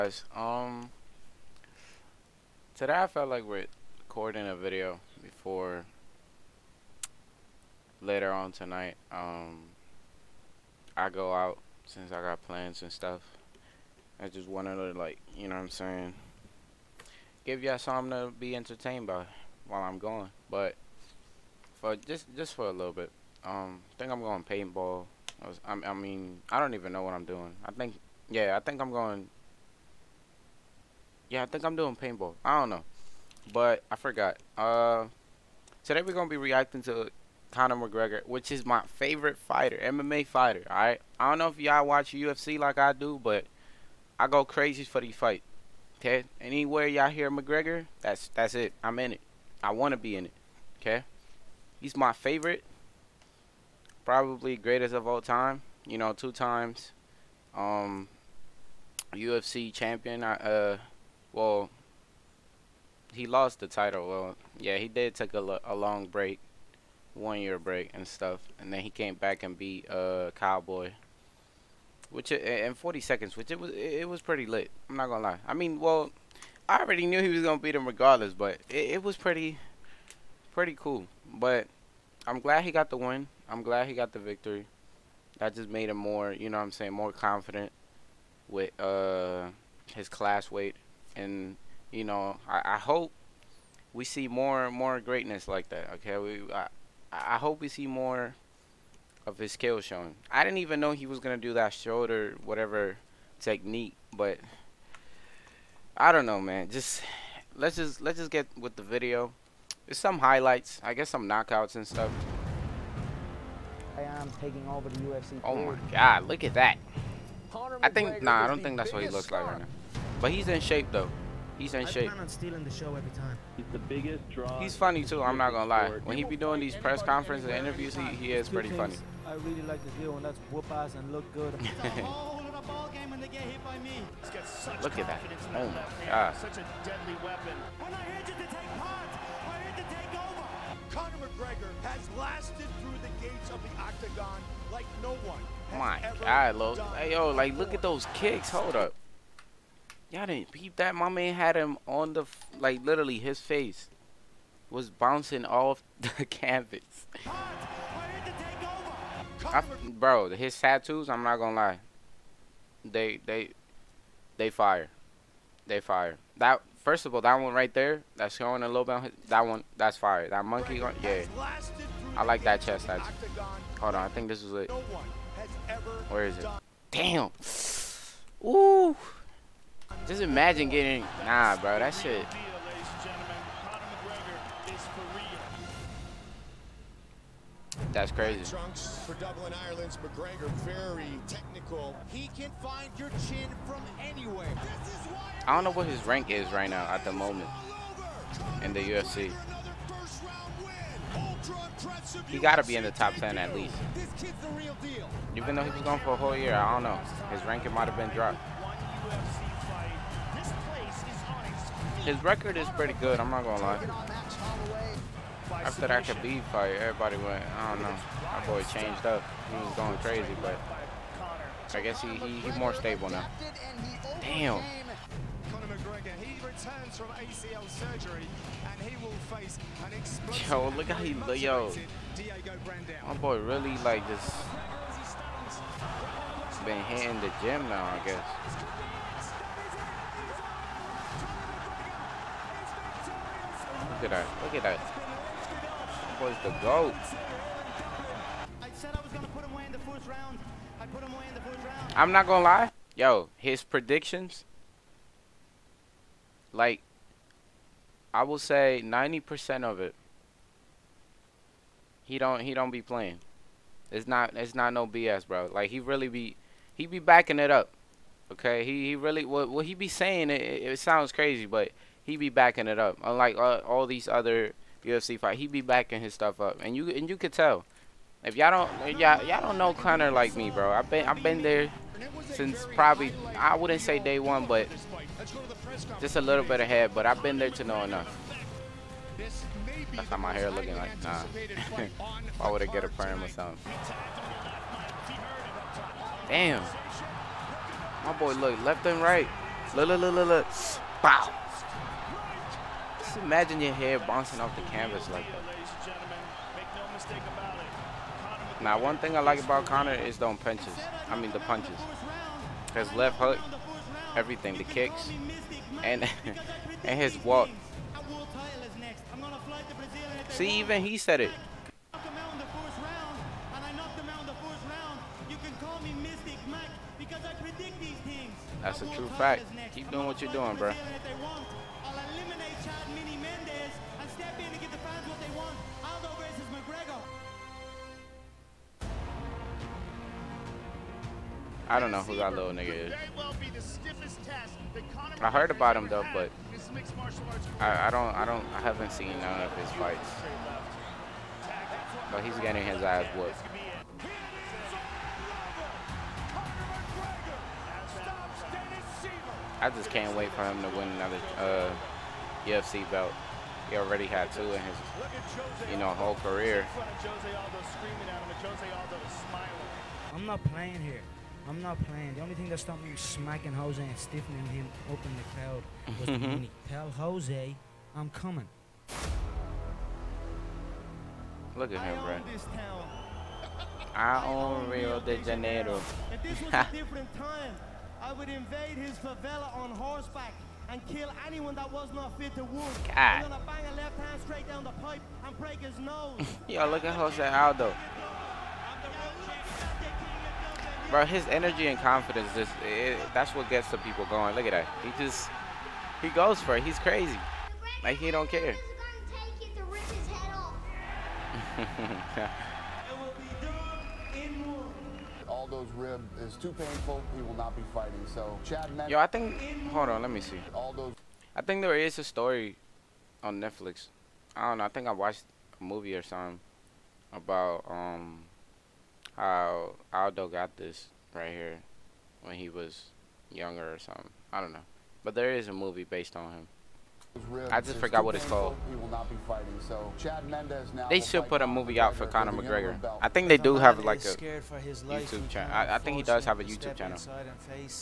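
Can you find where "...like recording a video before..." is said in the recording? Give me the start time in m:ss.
0:03.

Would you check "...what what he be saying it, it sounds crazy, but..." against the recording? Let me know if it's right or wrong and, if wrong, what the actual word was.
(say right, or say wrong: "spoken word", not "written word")
right.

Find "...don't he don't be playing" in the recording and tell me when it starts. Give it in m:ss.
4:22.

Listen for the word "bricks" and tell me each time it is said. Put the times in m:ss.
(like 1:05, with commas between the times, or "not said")
not said.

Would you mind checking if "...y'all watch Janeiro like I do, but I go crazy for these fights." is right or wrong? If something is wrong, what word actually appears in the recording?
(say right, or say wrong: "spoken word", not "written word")
wrong: "UFC", not "Janeiro".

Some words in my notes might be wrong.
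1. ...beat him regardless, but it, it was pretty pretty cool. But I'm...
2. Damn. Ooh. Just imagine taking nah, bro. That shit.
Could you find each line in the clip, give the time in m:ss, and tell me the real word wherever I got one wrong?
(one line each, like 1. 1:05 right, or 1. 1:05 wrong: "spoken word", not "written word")
1. 1:17 right
2. 2:56 wrong: "getting", not "taking".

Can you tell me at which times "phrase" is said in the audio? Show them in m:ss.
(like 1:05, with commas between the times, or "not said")
not said.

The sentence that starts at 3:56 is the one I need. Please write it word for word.
been hitting the gym now, I guess.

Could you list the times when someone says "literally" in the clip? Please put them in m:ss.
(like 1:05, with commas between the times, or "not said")
2:32.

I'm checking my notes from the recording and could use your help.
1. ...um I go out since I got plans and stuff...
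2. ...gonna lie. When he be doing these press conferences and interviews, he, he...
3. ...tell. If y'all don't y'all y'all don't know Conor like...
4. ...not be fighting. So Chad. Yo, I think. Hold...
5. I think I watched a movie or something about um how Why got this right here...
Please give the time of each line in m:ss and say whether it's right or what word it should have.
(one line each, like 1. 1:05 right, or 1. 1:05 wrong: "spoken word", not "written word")
1. 0:09 right
2. 2:05 right
3. 4:37 right
4. 6:57 right
5. 7:04 wrong: "Aldo", not "Why".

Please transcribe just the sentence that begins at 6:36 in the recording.
Yo, look at Jose Aldo bro, his energy and confidence just that's what gets the people going.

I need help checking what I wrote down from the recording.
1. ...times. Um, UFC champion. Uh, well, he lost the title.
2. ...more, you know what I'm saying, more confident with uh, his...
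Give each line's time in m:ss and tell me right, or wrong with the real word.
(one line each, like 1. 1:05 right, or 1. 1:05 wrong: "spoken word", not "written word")
1. 0:56 right
2. 1:25 right.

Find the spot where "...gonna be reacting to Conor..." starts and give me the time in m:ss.
0:36.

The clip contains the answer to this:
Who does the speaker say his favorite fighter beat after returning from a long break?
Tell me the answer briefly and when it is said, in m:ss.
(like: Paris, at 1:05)
Cowboy, at 1:10.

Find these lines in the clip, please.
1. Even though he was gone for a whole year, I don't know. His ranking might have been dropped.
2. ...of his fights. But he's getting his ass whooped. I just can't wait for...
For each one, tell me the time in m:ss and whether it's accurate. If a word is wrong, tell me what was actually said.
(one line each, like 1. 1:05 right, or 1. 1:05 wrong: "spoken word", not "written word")
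1. 3:25 right
2. 5:49 right.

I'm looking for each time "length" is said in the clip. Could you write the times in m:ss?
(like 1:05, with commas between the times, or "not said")
not said.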